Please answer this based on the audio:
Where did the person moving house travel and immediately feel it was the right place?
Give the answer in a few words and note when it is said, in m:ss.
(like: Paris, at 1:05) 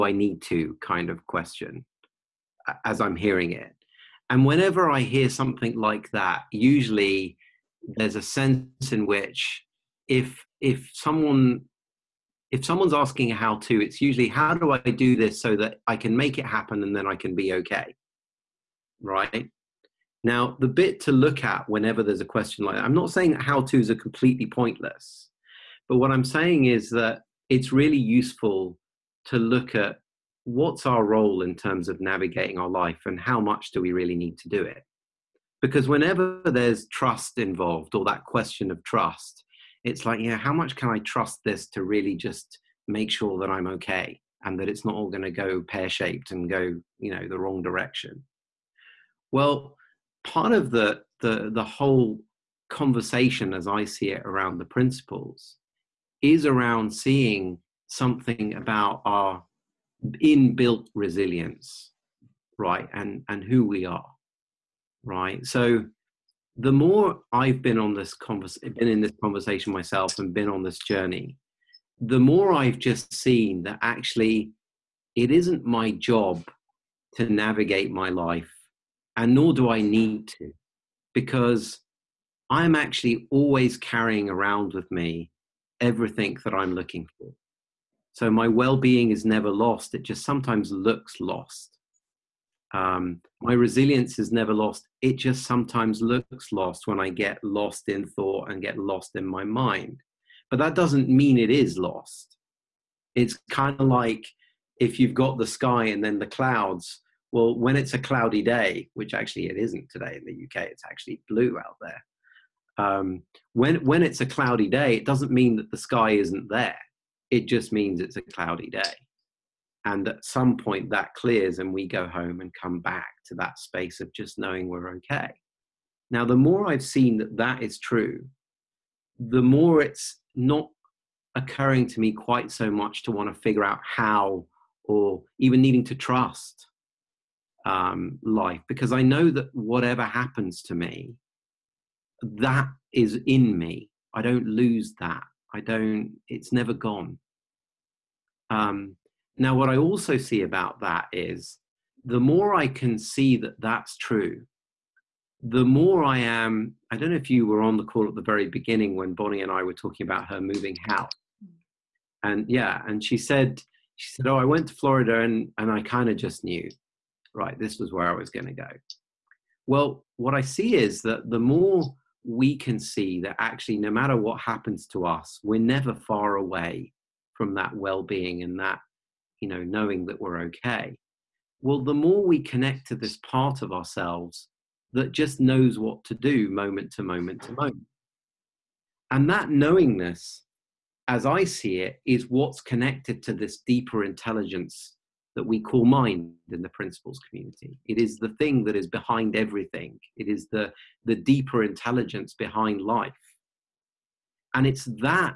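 Florida, at 2:44.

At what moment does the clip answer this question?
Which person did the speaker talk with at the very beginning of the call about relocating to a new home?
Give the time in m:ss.
2:39.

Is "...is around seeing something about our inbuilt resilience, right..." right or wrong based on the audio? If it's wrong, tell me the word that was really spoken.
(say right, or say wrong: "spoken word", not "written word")
right.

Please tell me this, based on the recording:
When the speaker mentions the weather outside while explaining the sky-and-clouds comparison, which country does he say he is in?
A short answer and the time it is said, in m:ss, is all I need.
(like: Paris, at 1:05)
UK, at 1:50.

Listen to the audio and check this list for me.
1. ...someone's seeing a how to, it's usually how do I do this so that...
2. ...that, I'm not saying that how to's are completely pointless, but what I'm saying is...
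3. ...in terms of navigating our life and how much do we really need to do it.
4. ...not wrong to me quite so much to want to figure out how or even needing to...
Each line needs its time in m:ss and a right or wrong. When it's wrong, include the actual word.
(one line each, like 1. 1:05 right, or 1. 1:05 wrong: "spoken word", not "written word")
1. 0:12 wrong: "asking", not "seeing"
2. 0:22 right
3. 0:31 right
4. 2:10 wrong: "occurring", not "wrong".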